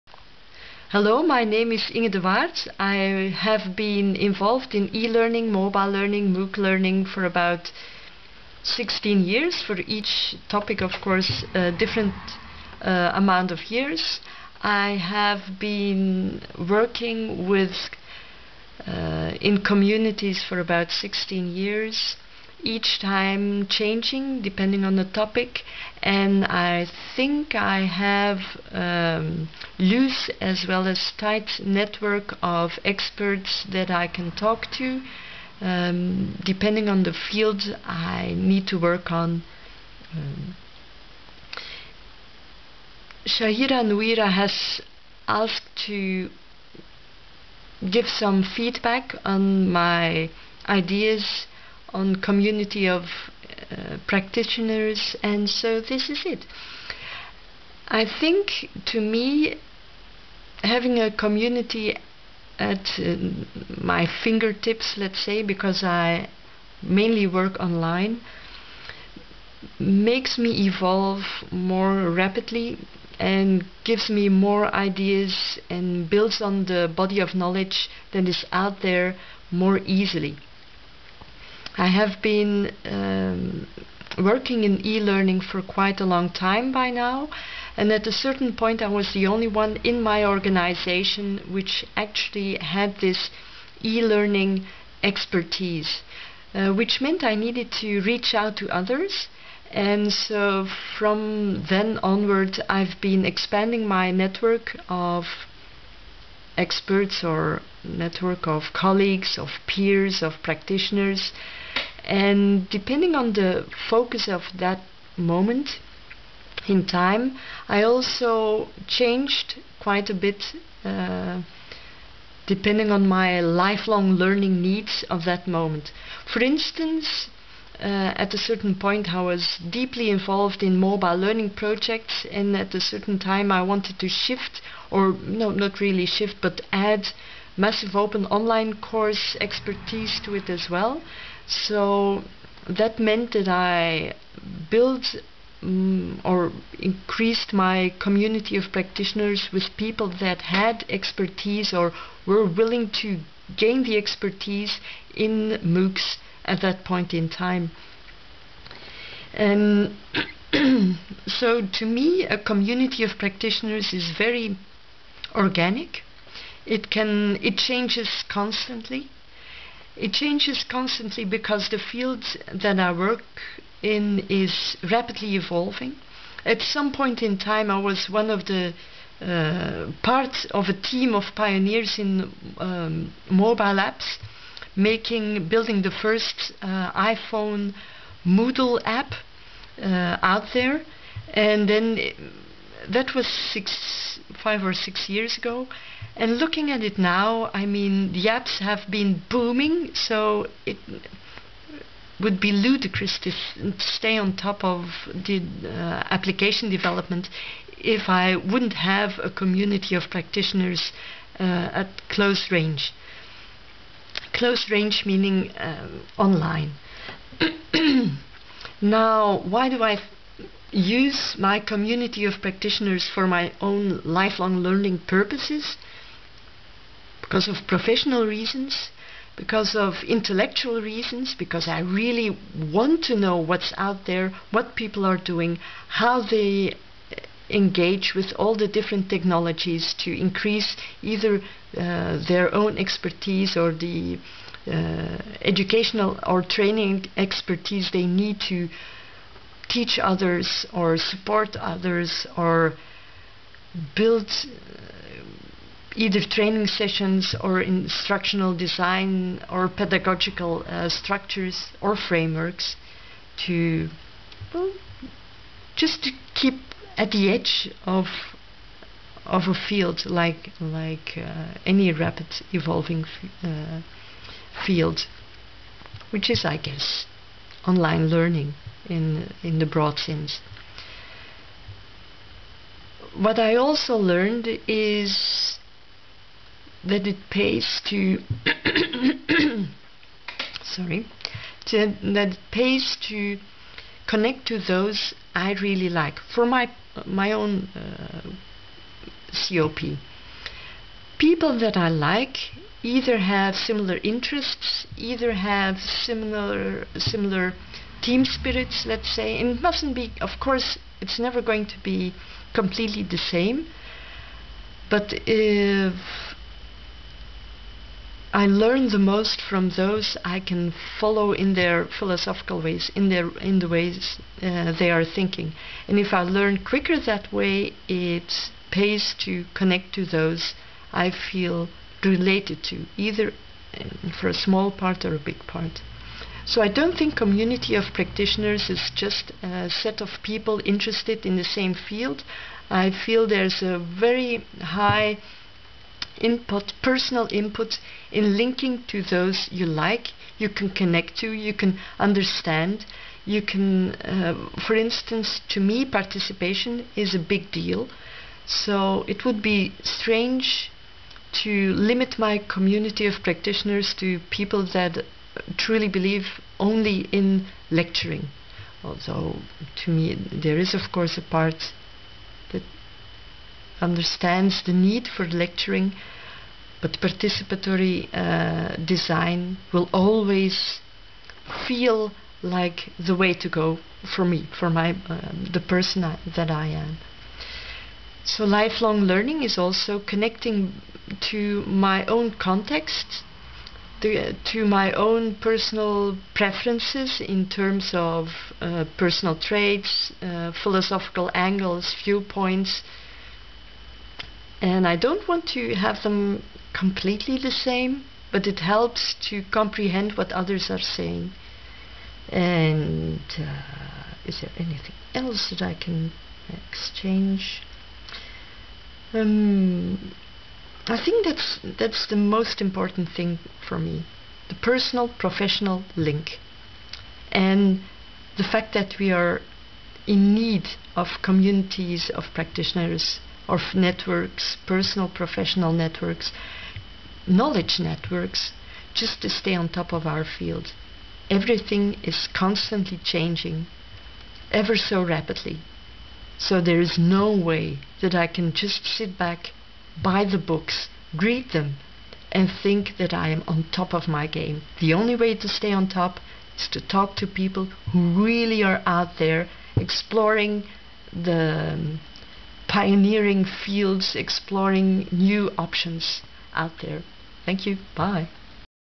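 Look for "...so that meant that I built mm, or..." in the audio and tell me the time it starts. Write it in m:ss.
2:21.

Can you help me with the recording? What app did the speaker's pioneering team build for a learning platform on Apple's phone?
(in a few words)
iPhone Moodle app.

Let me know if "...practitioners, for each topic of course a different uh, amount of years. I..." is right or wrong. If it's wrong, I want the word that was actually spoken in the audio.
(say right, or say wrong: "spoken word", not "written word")
wrong: "years", not "practitioners".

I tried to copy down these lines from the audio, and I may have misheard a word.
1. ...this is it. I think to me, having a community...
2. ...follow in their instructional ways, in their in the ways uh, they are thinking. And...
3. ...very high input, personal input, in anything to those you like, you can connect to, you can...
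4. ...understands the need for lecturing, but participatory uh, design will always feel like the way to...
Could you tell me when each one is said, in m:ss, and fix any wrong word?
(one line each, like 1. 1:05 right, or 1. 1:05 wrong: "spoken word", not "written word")
1. 0:55 right
2. 5:20 wrong: "philosophical", not "instructional"
3. 5:43 wrong: "linking", not "anything"
4. 6:13 right.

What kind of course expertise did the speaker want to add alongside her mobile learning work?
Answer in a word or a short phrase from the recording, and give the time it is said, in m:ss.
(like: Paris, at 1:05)
massive open online course, at 2:17.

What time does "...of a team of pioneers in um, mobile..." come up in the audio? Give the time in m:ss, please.
3:00.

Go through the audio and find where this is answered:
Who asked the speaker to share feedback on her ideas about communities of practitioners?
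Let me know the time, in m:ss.
0:43.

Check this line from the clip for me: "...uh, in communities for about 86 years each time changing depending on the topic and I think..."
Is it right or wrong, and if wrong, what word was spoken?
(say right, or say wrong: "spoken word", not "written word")
wrong: "16", not "86".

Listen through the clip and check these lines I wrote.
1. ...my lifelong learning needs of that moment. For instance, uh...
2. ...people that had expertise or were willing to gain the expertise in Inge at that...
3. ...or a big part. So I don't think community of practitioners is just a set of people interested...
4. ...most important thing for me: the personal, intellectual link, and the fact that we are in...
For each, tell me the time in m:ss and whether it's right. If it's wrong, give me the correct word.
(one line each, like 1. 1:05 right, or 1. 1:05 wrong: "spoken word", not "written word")
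1. 2:03 right
2. 2:29 wrong: "MOOCs", not "Inge"
3. 5:35 right
4. 7:02 wrong: "professional", not "intellectual".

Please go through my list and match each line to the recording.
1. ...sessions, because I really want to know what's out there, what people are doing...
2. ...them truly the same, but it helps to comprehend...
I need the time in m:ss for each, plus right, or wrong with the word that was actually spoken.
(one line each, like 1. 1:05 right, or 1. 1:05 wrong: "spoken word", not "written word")
1. 3:50 wrong: "reasons", not "sessions"
2. 6:46 wrong: "completely", not "truly".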